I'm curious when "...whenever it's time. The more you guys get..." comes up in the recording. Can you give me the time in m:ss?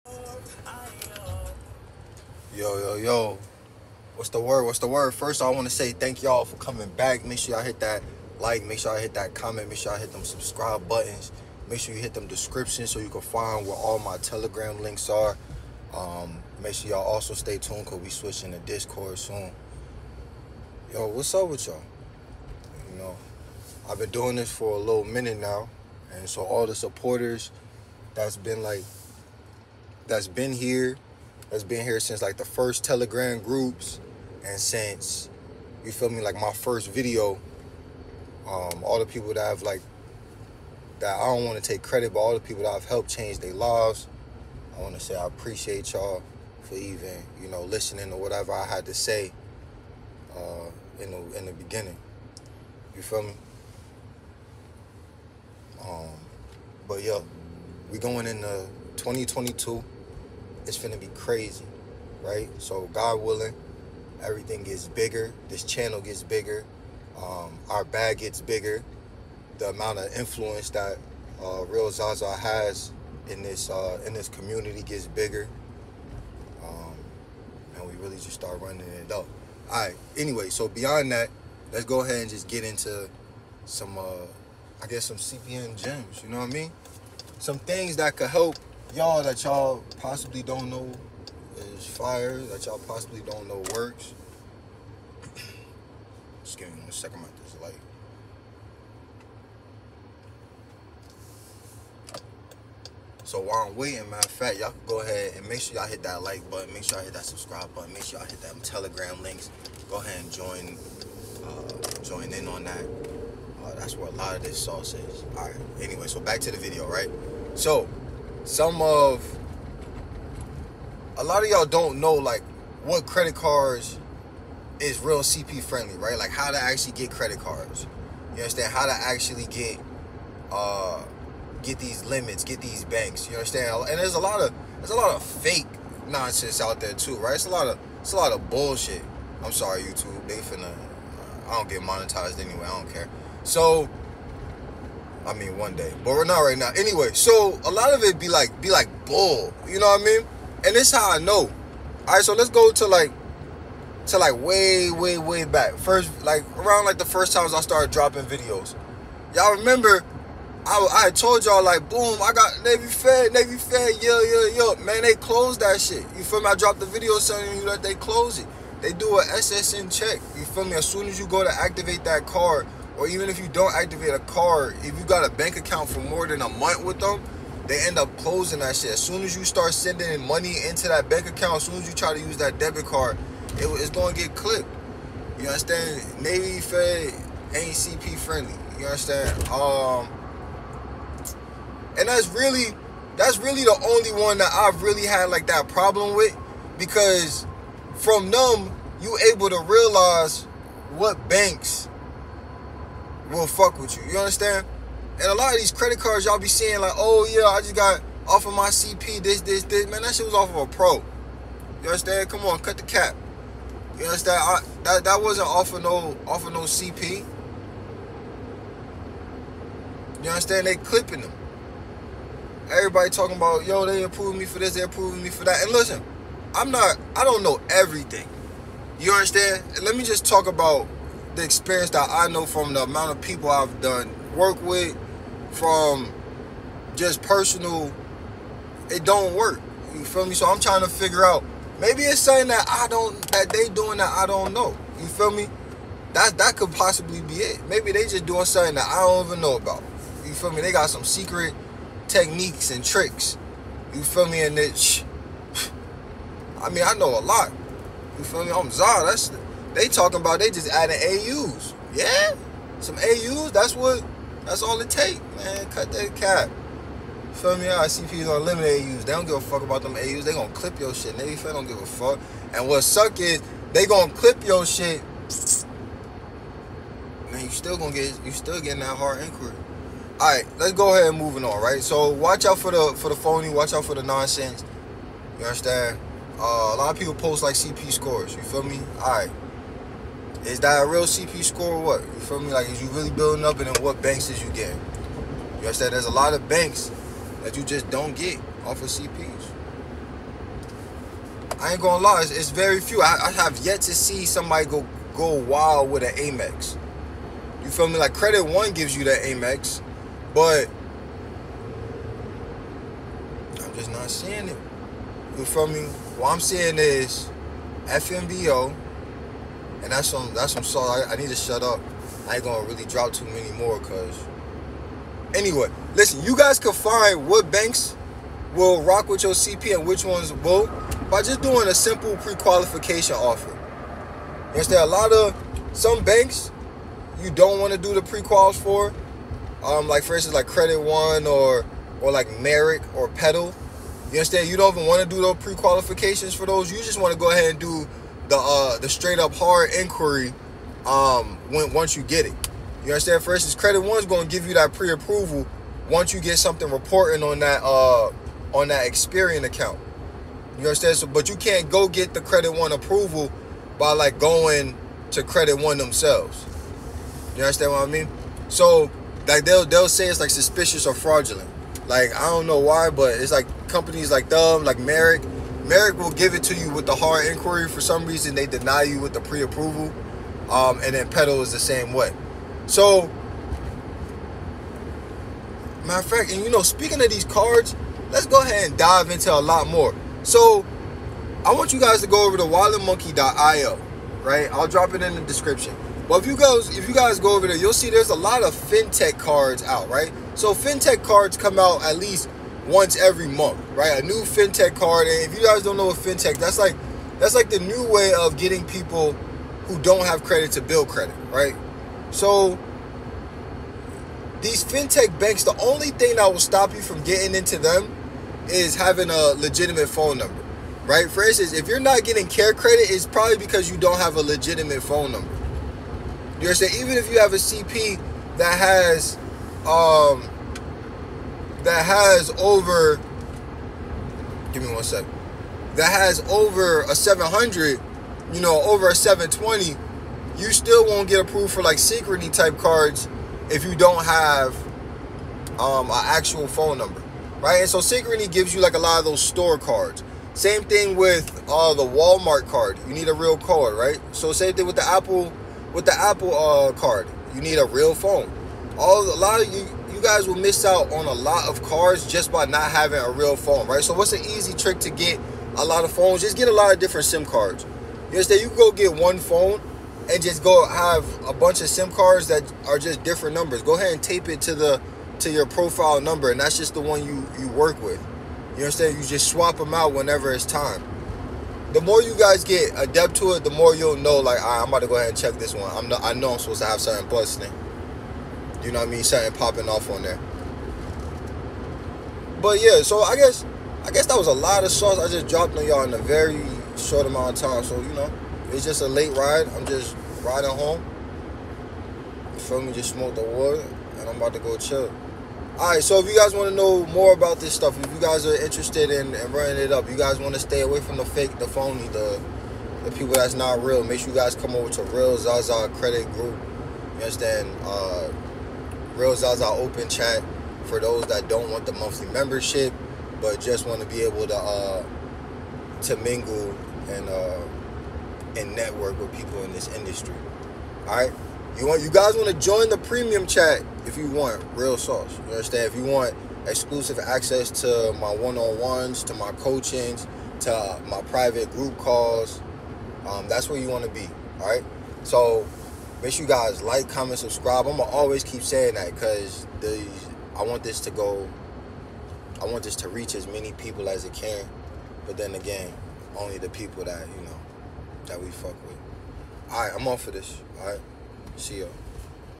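7:59.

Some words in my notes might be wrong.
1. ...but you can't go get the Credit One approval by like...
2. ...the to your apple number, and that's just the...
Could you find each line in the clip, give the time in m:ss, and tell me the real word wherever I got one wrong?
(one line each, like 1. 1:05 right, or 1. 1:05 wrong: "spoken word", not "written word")
1. 6:01 right
2. 7:54 wrong: "profile", not "apple".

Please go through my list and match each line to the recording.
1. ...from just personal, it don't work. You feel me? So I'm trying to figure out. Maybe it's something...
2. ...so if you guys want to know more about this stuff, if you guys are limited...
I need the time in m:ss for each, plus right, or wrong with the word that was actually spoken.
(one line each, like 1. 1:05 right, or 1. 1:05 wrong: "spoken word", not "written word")
1. 3:55 right
2. 8:25 wrong: "interested", not "limited".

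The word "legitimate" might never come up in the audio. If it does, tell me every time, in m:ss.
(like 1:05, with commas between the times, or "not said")
6:59, 7:04.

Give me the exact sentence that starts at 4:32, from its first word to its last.
And what suck is they gonna clip your shit.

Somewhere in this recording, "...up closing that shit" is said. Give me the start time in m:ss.
2:57.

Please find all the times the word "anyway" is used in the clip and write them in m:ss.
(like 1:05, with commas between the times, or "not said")
1:20, 1:55, 2:22, 2:26, 5:25.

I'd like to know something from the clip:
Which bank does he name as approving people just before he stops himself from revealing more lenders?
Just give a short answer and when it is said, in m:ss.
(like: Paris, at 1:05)
FNBO, at 5:17.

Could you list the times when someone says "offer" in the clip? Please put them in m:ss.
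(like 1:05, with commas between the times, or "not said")
5:33.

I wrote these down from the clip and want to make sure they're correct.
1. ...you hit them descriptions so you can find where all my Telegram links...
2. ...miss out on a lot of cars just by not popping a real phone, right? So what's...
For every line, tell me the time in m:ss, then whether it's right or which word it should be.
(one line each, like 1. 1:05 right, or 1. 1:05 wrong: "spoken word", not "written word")
1. 0:11 right
2. 7:40 wrong: "having", not "popping".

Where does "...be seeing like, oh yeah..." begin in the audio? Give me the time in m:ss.
3:26.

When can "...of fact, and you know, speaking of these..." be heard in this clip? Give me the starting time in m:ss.
6:25.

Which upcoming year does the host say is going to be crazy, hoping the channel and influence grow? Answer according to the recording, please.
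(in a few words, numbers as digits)
2022.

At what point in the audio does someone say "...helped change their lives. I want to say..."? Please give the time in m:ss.
0:42.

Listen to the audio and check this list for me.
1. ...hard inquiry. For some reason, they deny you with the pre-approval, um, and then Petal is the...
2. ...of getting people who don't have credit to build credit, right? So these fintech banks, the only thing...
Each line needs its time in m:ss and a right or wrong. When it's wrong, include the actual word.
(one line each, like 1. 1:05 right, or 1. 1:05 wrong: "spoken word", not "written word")
1. 6:16 right
2. 6:48 right.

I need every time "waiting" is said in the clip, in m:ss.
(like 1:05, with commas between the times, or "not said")
1:43.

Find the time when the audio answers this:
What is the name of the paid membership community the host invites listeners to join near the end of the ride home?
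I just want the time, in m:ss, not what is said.
8:34.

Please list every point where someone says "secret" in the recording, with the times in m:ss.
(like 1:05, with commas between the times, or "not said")
4:11.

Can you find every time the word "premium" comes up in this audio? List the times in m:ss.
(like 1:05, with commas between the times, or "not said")
8:52.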